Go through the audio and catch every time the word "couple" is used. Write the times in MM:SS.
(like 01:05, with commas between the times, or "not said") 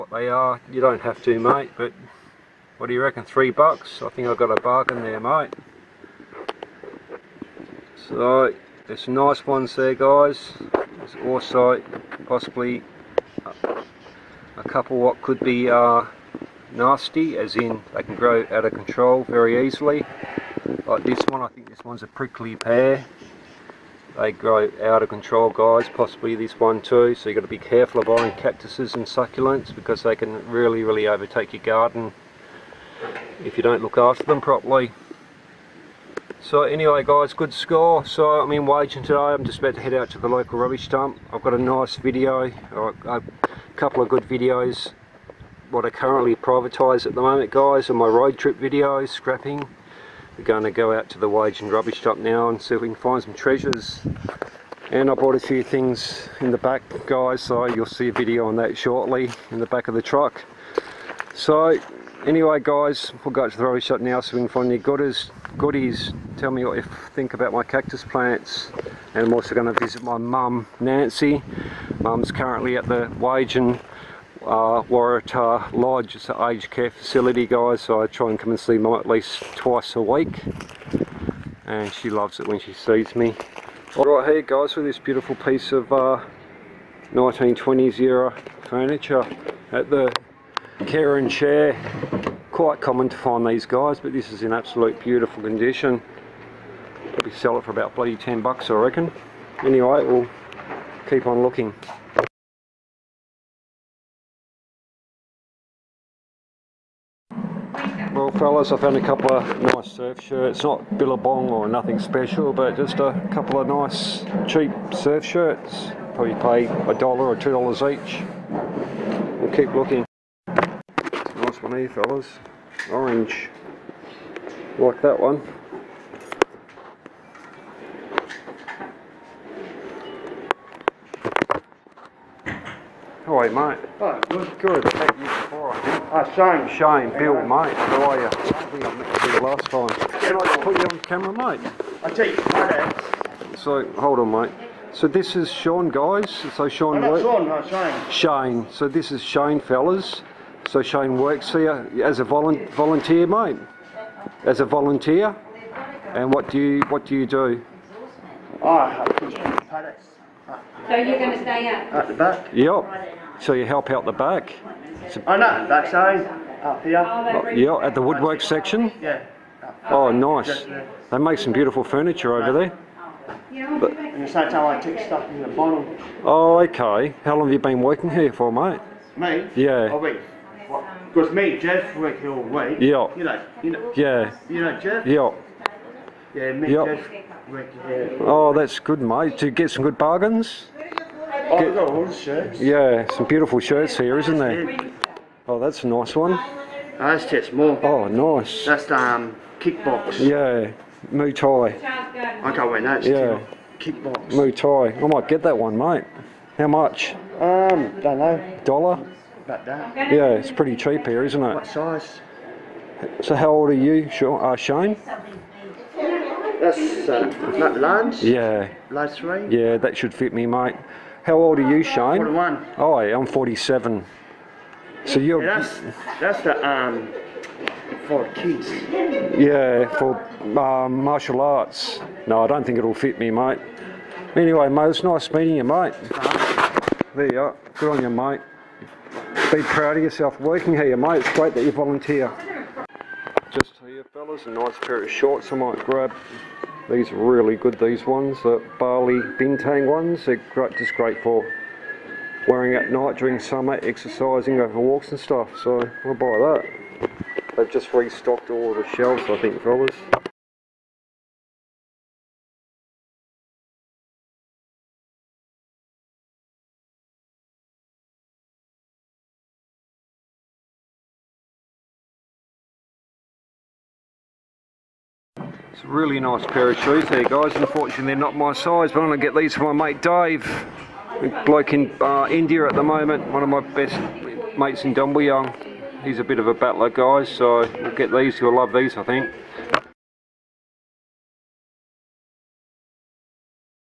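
00:14, 00:43, 01:49, 01:53.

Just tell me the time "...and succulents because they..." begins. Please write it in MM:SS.
00:28.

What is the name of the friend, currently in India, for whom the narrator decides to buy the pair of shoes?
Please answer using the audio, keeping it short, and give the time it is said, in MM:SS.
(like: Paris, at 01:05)
Dave, at 04:40.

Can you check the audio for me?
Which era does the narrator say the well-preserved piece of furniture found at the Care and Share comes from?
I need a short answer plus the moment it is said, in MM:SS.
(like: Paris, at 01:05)
1920s, at 01:27.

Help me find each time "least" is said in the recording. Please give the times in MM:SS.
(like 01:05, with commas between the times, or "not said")
01:19.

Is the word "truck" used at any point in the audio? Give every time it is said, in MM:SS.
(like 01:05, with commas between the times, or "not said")
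01:00.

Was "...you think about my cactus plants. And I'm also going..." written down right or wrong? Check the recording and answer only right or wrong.
right.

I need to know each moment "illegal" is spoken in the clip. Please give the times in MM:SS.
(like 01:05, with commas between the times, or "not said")
not said.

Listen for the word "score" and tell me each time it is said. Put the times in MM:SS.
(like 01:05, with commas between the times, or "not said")
00:37.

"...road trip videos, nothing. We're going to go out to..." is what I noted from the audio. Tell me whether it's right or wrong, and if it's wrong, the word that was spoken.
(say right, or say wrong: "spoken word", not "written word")
wrong: "scrapping", not "nothing".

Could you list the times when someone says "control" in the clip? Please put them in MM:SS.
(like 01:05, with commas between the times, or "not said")
00:18, 00:25.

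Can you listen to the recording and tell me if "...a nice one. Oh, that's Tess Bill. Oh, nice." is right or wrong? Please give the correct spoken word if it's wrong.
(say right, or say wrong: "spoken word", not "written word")
wrong: "Moore", not "Bill".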